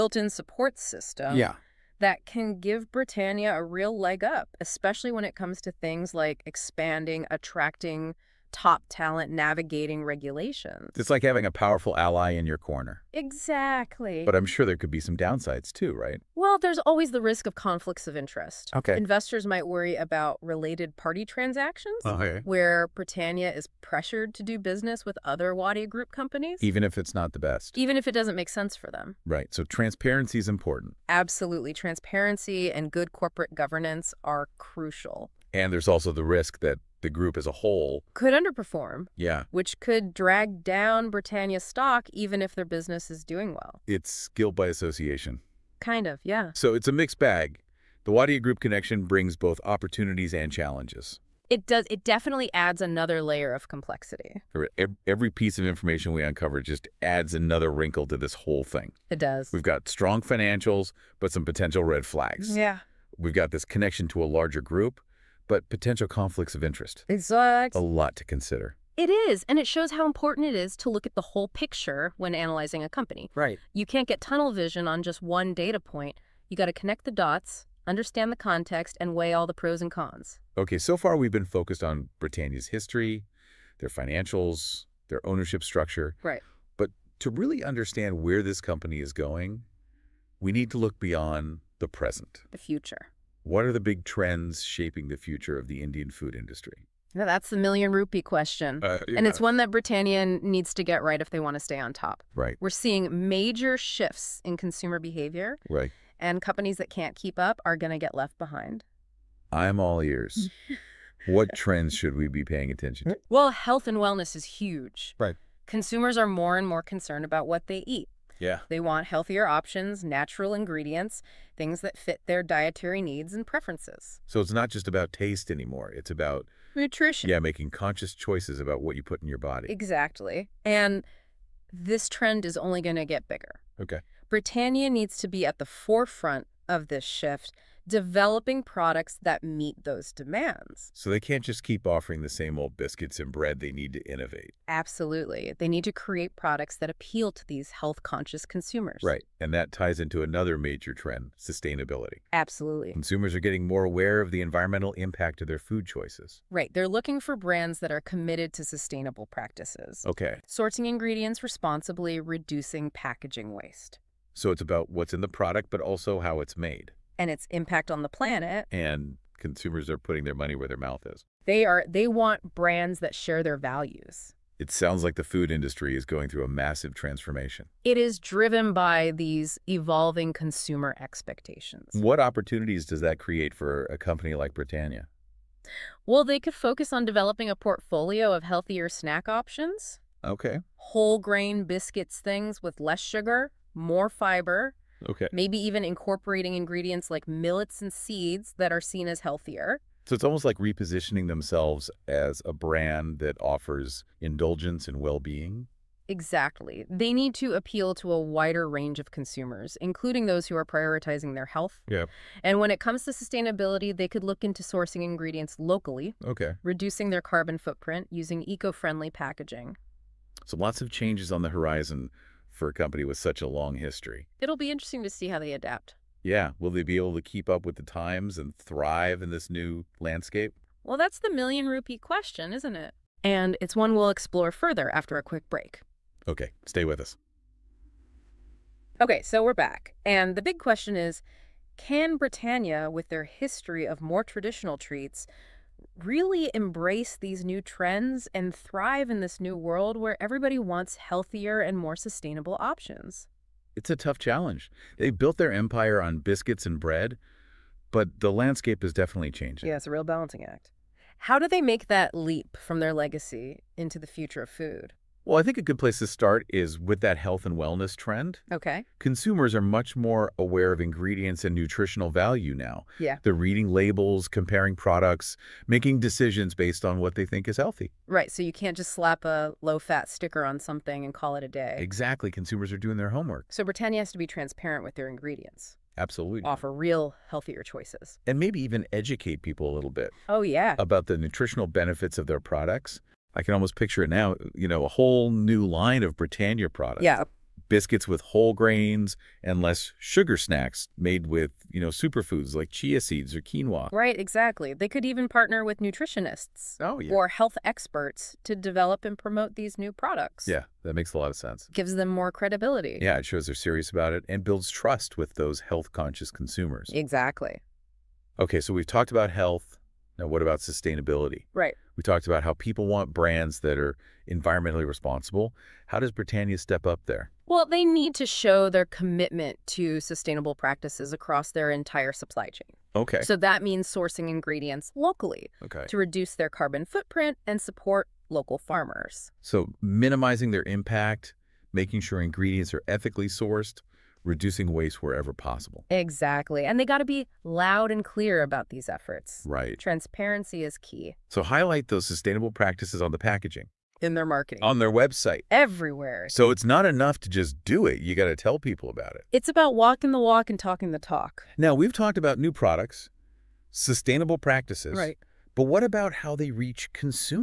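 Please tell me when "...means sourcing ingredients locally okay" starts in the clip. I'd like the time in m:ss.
5:33.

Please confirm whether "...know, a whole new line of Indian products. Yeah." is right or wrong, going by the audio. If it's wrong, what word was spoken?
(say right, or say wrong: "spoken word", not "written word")
wrong: "Britannia", not "Indian".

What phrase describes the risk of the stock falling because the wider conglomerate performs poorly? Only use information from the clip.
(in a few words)
Guilt by association.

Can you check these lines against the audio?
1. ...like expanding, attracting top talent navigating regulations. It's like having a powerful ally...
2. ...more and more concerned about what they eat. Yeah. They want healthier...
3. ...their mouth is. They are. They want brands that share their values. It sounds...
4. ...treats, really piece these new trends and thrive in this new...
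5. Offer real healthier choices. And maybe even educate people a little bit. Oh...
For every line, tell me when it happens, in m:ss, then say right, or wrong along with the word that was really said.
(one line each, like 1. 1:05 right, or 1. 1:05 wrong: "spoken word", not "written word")
1. 0:06 right
2. 1:56 right
3. 2:50 right
4. 4:04 wrong: "embrace", not "piece"
5. 4:46 right.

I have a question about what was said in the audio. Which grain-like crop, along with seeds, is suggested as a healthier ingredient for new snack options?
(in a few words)
Millets.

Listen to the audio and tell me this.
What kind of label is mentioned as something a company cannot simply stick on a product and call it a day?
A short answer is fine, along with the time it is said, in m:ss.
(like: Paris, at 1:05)
Low-fat sticker, at 4:39.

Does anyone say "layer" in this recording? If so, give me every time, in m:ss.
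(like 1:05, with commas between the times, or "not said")
0:53.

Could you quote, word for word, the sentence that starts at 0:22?
where Britannia is pressured to do business with other Wadia Group companies.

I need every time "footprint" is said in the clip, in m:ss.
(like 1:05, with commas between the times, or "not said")
3:37, 5:36.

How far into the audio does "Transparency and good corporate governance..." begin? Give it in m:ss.
0:31.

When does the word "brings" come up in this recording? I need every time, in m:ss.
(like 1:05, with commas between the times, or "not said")
0:49.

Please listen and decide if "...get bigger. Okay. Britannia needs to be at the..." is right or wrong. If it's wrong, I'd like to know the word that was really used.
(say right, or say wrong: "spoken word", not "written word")
right.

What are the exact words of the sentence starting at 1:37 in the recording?
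Now that's the million rupee question.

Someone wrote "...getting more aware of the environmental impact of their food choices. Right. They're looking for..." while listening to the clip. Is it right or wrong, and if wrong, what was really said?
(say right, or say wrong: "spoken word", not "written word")
right.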